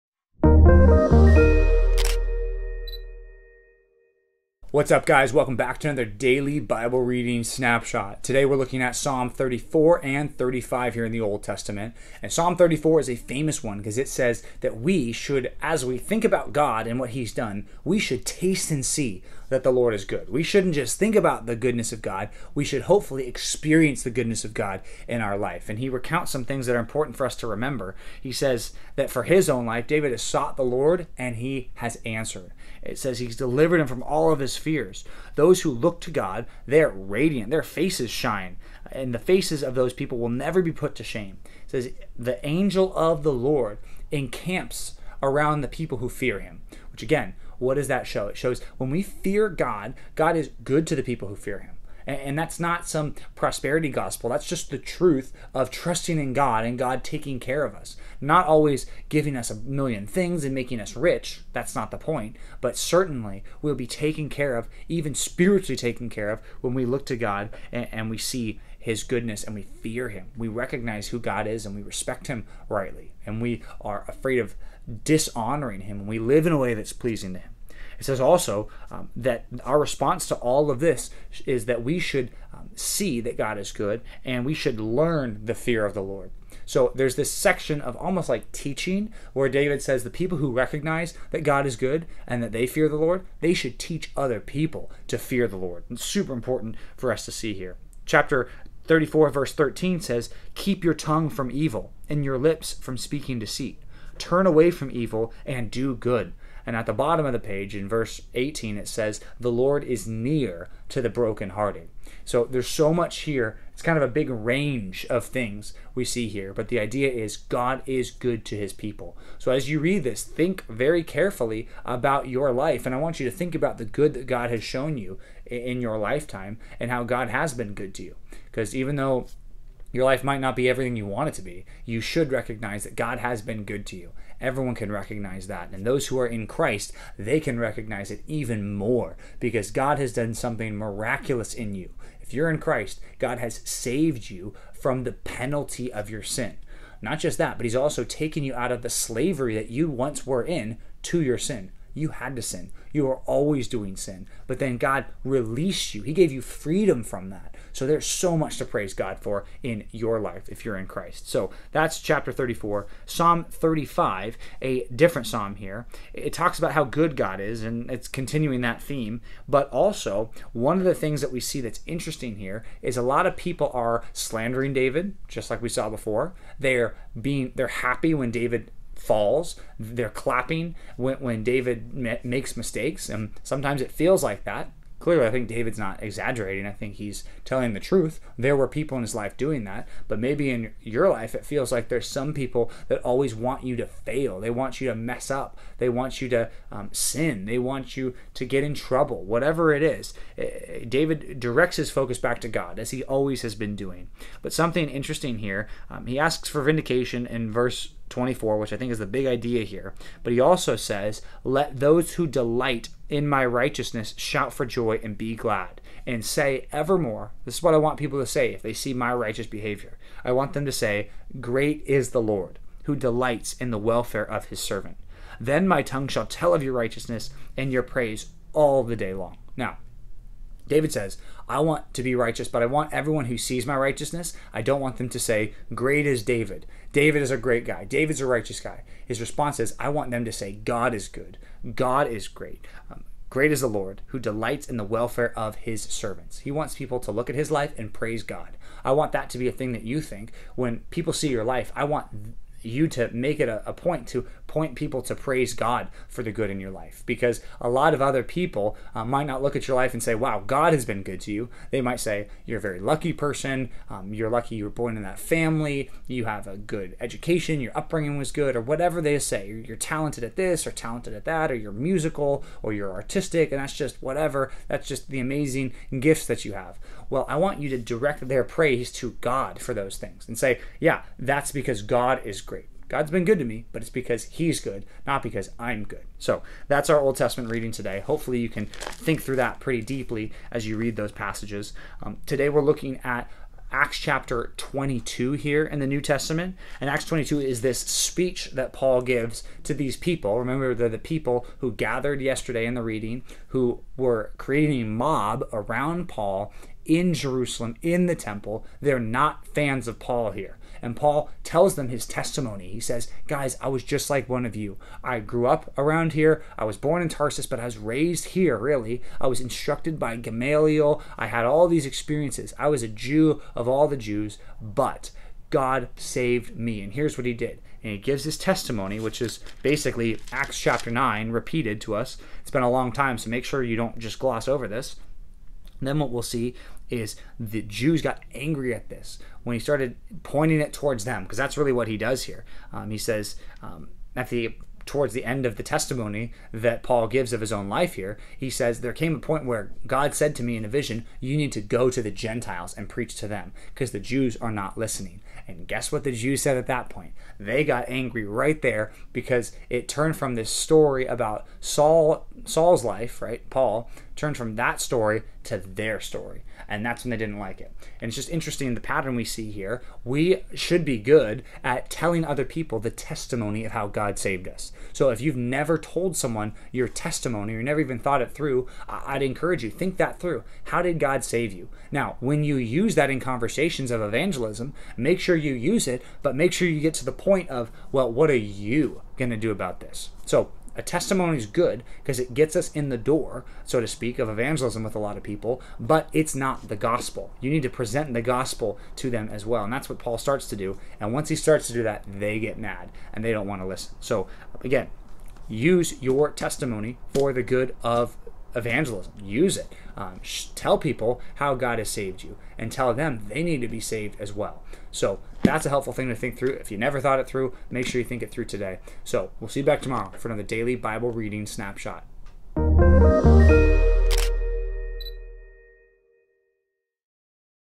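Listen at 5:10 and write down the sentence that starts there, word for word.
And Paul tells them his testimony.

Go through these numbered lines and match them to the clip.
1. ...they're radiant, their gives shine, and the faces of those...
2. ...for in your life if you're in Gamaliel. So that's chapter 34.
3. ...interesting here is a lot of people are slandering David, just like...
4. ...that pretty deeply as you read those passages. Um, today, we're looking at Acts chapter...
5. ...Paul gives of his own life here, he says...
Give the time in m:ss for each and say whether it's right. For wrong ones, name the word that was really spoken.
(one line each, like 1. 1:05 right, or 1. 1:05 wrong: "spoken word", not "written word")
1. 0:36 wrong: "faces", not "gives"
2. 2:39 wrong: "Christ", not "Gamaliel"
3. 2:51 right
4. 4:49 right
5. 5:46 right.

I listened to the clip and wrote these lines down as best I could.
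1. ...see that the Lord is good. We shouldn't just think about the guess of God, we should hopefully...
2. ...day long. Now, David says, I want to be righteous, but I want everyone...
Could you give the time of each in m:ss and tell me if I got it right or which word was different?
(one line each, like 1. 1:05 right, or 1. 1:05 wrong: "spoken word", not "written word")
1. 0:18 wrong: "goodness", not "guess"
2. 3:48 right.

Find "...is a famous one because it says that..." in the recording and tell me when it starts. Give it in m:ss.
0:13.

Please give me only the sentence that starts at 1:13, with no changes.
And we are afraid of dishonoring Him.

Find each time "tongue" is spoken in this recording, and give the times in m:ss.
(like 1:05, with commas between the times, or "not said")
1:40, 3:45.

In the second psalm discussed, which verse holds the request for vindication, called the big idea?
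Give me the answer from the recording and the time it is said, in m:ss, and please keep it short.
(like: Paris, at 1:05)
24, at 3:27.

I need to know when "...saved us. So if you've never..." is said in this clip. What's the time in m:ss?
6:14.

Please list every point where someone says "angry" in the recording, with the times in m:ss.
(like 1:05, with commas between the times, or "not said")
5:38, 5:57.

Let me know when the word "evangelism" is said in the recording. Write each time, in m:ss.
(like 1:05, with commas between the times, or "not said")
6:24, 6:34, 6:48.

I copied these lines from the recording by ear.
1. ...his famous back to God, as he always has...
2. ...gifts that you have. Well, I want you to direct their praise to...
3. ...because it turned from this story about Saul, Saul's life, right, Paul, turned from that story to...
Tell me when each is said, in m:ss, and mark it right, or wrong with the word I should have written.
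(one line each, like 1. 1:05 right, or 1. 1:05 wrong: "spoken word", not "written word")
1. 3:21 wrong: "focus", not "famous"
2. 4:35 right
3. 5:59 right.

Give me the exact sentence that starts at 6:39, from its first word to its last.
And that's what Paul starts to do.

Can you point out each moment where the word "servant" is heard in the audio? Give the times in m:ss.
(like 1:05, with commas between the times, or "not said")
3:44, 4:05.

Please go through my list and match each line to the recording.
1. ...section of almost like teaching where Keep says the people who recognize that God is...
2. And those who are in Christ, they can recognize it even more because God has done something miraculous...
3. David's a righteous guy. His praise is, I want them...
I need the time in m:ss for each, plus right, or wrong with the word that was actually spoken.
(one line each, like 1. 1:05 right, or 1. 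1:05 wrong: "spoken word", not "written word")
1. 1:27 wrong: "David", not "Keep"
2. 2:15 right
3. 3:57 wrong: "response", not "praise".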